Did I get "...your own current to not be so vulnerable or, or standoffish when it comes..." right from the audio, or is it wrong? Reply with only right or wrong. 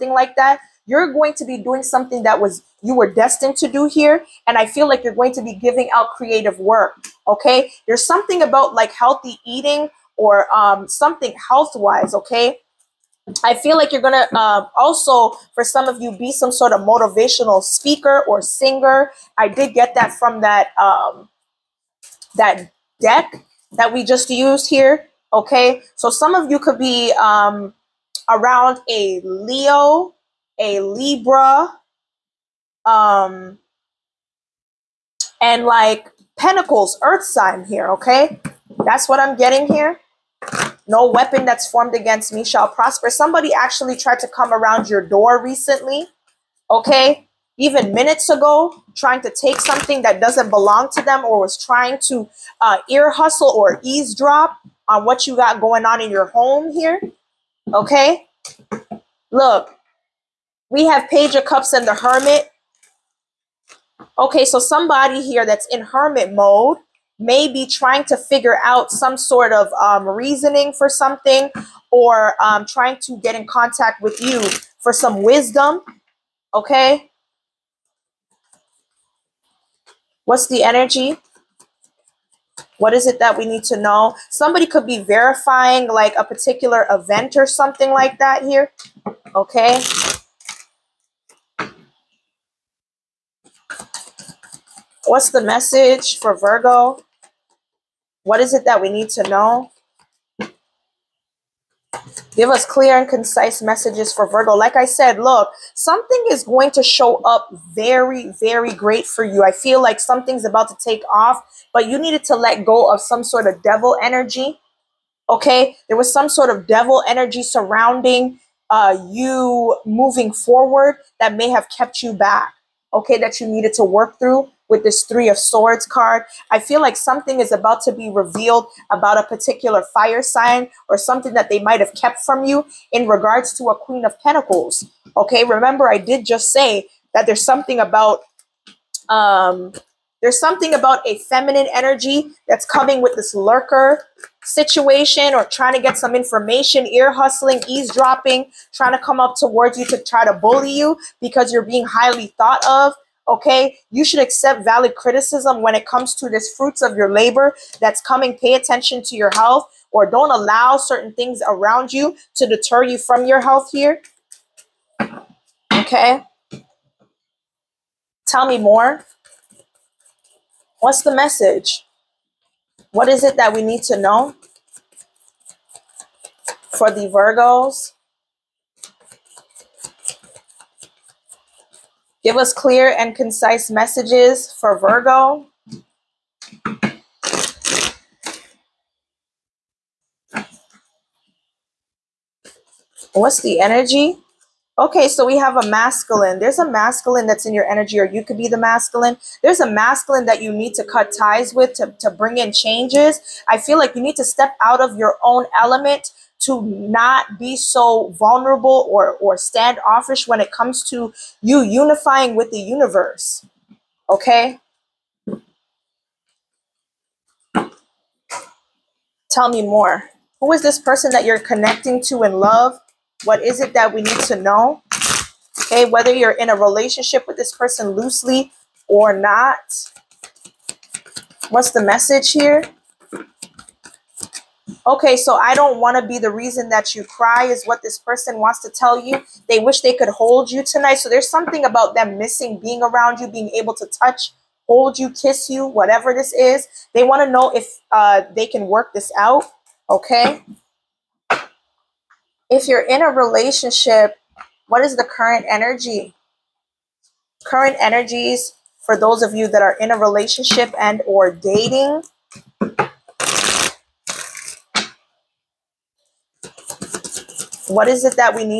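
wrong.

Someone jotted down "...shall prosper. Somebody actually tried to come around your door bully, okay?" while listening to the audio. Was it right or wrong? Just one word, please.
wrong.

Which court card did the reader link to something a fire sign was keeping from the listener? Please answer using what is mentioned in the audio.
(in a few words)
Queen of Pentacles.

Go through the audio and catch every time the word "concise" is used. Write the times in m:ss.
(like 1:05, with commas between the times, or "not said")
1:43, 3:03.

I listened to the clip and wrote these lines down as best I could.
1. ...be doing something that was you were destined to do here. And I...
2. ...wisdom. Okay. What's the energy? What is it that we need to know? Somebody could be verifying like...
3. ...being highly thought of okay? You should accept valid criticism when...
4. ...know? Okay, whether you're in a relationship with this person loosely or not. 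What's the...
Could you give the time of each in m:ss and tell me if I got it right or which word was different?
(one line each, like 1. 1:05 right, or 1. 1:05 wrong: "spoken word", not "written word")
1. 0:01 right
2. 1:15 right
3. 2:31 right
4. 3:44 right.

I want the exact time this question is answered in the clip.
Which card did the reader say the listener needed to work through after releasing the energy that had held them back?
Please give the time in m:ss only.
2:05.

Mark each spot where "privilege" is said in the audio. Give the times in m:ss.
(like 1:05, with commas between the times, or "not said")
not said.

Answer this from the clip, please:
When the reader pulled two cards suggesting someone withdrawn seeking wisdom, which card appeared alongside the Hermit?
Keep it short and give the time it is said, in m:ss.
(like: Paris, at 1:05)
Page of Cups, at 1:01.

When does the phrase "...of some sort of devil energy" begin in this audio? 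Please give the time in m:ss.
1:52.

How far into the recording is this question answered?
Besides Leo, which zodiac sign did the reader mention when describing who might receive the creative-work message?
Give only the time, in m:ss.
0:30.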